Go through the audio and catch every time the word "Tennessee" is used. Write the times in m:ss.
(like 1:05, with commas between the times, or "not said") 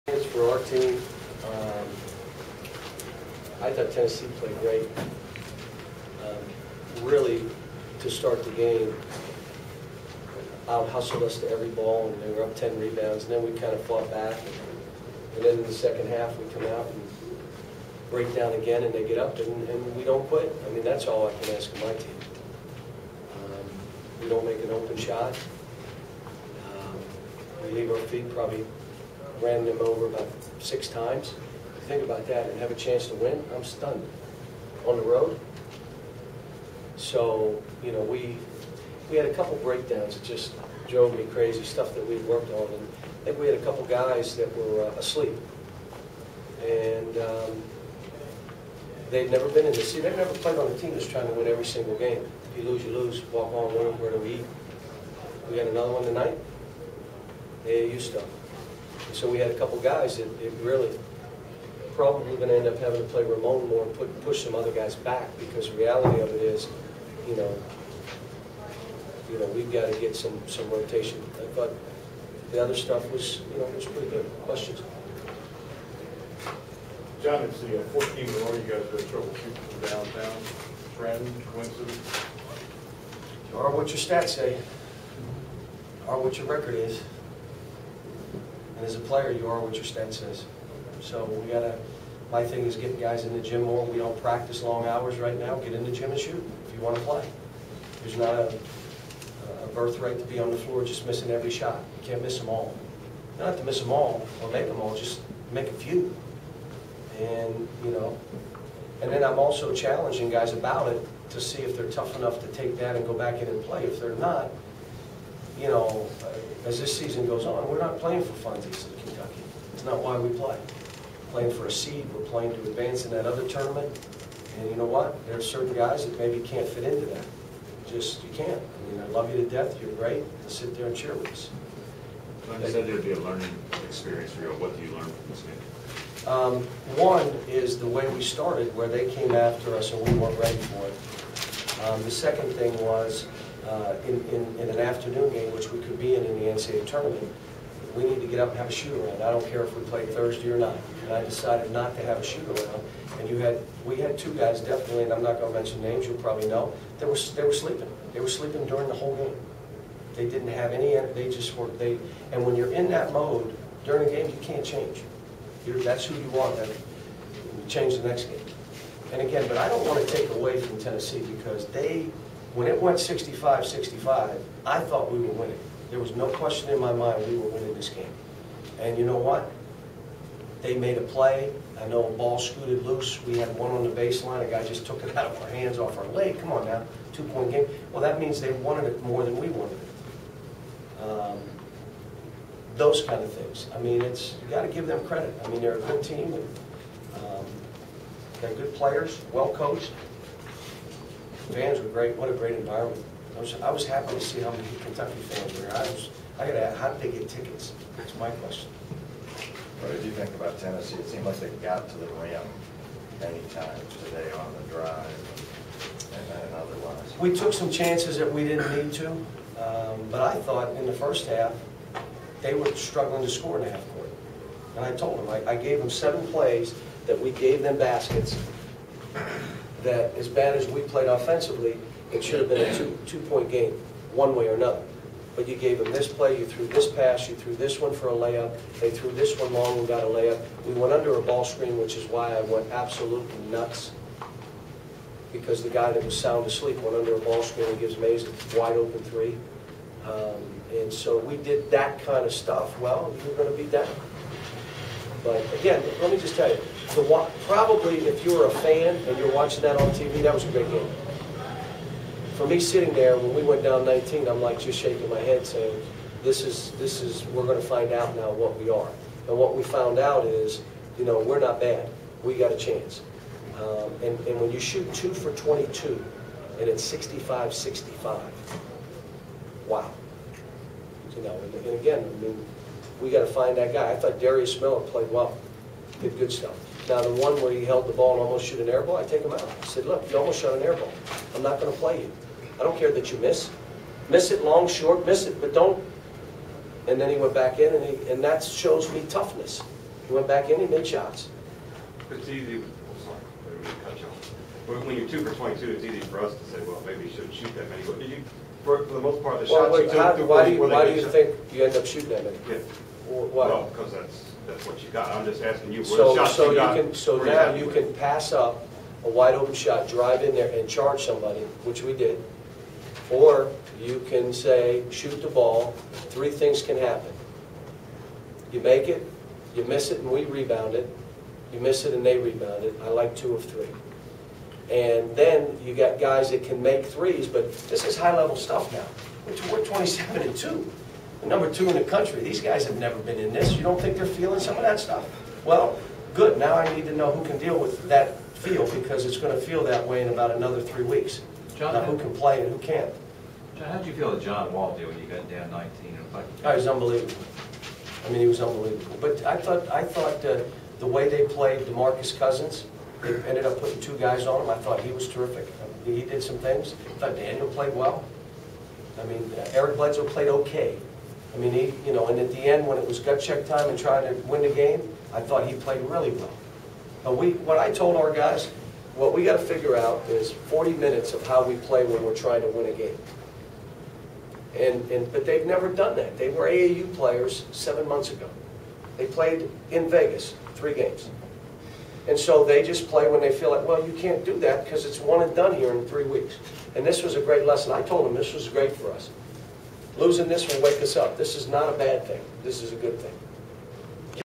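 0:03, 2:50, 3:30.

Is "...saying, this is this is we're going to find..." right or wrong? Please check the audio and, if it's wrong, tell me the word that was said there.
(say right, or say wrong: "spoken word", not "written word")
right.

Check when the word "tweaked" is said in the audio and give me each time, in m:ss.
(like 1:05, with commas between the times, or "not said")
not said.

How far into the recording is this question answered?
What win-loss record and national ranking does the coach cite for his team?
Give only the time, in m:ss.
5:39.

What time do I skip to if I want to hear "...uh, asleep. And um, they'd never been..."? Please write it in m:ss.
0:44.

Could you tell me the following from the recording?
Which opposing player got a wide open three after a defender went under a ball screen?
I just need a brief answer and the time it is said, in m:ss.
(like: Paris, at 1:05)
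Maze, at 4:07.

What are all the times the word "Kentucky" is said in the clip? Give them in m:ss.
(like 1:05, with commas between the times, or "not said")
1:59, 3:24.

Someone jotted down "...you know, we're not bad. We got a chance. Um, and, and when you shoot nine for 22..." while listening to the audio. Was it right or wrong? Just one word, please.
wrong.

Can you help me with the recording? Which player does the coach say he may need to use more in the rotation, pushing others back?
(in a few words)
Ramon.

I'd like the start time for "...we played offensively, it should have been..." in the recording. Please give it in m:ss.
3:50.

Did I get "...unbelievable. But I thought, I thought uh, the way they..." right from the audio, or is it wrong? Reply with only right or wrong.
right.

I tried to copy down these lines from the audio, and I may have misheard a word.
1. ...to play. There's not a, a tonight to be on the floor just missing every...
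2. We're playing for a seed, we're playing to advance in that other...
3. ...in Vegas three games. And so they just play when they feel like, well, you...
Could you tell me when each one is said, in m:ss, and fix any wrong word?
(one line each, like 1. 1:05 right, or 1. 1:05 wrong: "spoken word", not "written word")
1. 1:36 wrong: "birthright", not "tonight"
2. 2:01 right
3. 6:29 right.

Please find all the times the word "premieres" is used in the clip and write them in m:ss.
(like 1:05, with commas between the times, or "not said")
not said.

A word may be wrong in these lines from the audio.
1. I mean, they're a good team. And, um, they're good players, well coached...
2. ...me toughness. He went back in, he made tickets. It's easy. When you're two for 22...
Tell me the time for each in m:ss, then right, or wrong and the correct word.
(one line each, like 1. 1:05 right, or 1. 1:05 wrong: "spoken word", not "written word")
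1. 3:15 right
2. 4:58 wrong: "shots", not "tickets".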